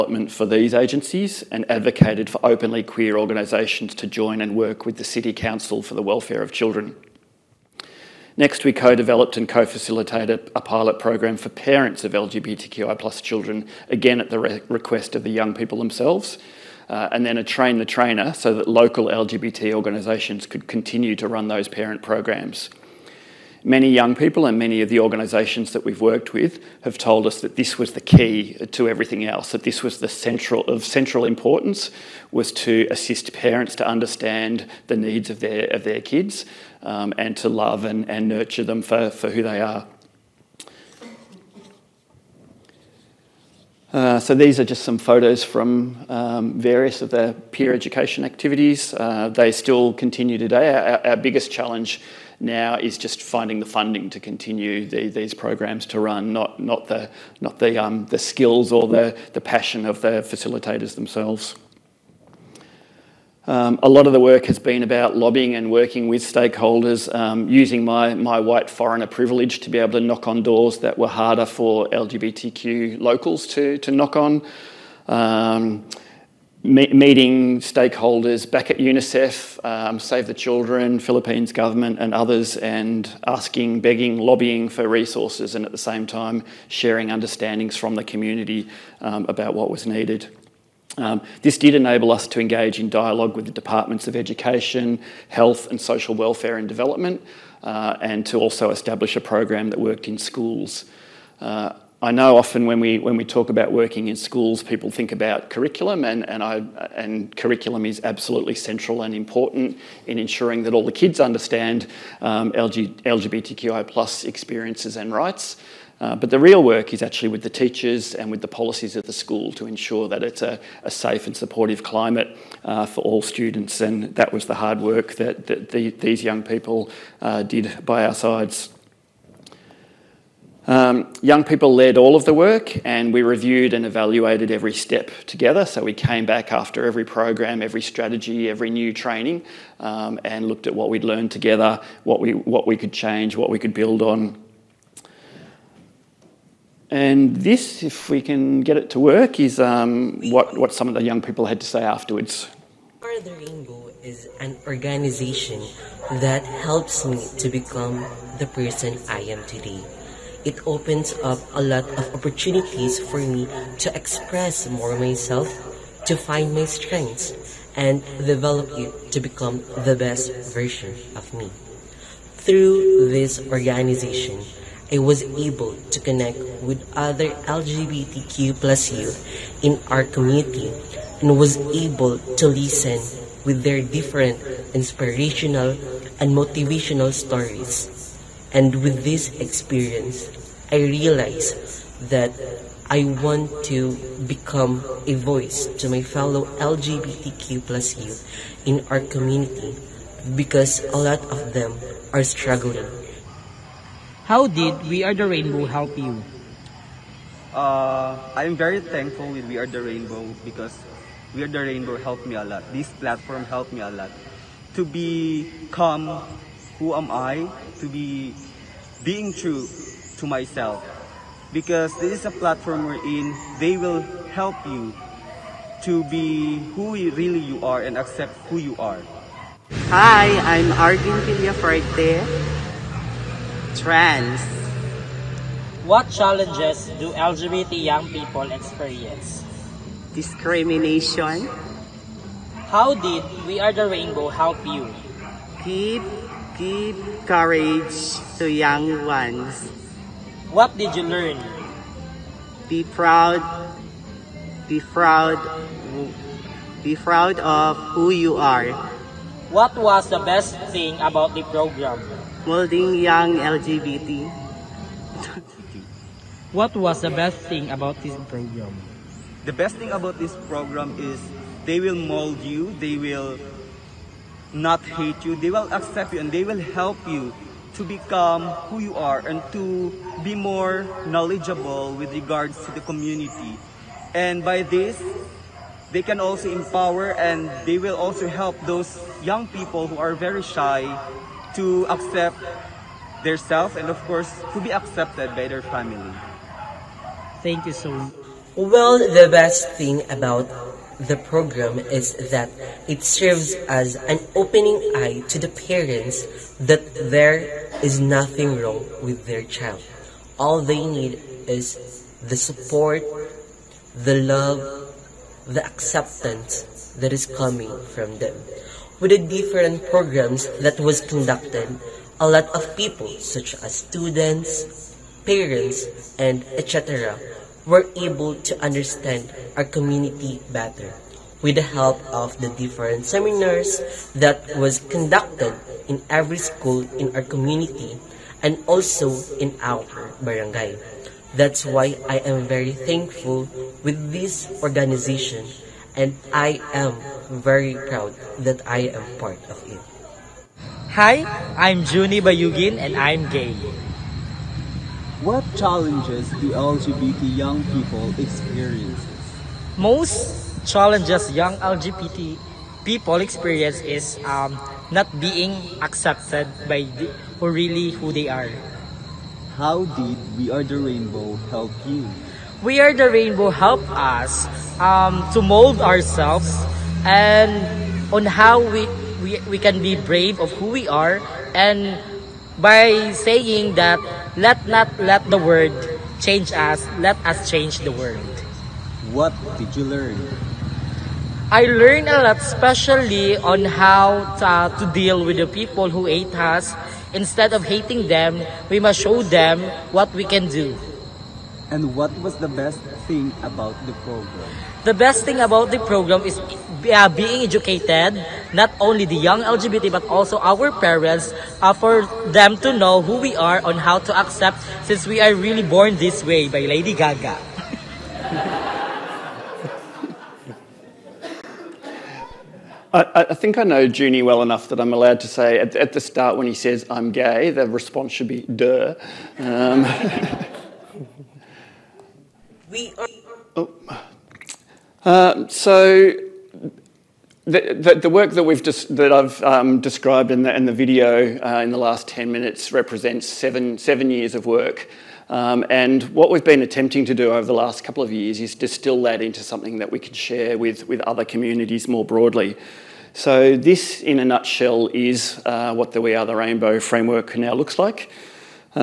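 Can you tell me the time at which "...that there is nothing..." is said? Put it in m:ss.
5:06.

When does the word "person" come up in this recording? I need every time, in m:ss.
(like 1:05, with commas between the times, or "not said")
2:38.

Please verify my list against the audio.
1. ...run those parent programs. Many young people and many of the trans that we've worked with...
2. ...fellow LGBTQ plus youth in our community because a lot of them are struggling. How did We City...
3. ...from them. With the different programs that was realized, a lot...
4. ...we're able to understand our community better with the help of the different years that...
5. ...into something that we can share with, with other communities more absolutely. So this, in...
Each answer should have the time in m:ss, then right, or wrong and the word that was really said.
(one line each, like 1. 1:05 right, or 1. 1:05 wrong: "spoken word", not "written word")
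1. 0:21 wrong: "organisations", not "trans"
2. 3:16 wrong: "Are", not "City"
3. 5:17 wrong: "conducted", not "realized"
4. 5:27 wrong: "seminars", not "years"
5. 7:29 wrong: "broadly", not "absolutely".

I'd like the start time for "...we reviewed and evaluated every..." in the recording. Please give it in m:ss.
2:13.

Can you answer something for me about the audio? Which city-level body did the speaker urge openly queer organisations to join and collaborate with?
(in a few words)
City Council for the Welfare of Children.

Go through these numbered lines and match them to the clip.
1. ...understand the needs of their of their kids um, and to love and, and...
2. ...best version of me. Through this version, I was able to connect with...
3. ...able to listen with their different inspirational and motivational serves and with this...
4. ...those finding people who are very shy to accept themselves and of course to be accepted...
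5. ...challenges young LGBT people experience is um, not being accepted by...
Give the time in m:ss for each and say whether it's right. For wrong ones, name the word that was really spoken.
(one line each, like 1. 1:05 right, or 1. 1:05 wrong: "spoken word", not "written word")
1. 0:33 right
2. 2:49 wrong: "organization", not "version"
3. 3:01 wrong: "stories", not "serves"
4. 4:48 wrong: "young", not "finding"
5. 6:00 right.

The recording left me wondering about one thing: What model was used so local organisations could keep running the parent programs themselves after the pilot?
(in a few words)
Train the trainer.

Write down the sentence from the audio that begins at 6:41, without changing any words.
And what was the best thing about the program?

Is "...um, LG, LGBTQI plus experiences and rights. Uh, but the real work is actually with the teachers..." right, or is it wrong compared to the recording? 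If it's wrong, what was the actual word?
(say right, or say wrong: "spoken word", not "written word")
right.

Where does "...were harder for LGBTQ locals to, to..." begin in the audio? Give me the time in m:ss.
1:10.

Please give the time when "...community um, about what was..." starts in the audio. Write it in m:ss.
1:28.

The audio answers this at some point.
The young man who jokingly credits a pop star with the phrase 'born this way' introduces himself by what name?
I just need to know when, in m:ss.
5:51.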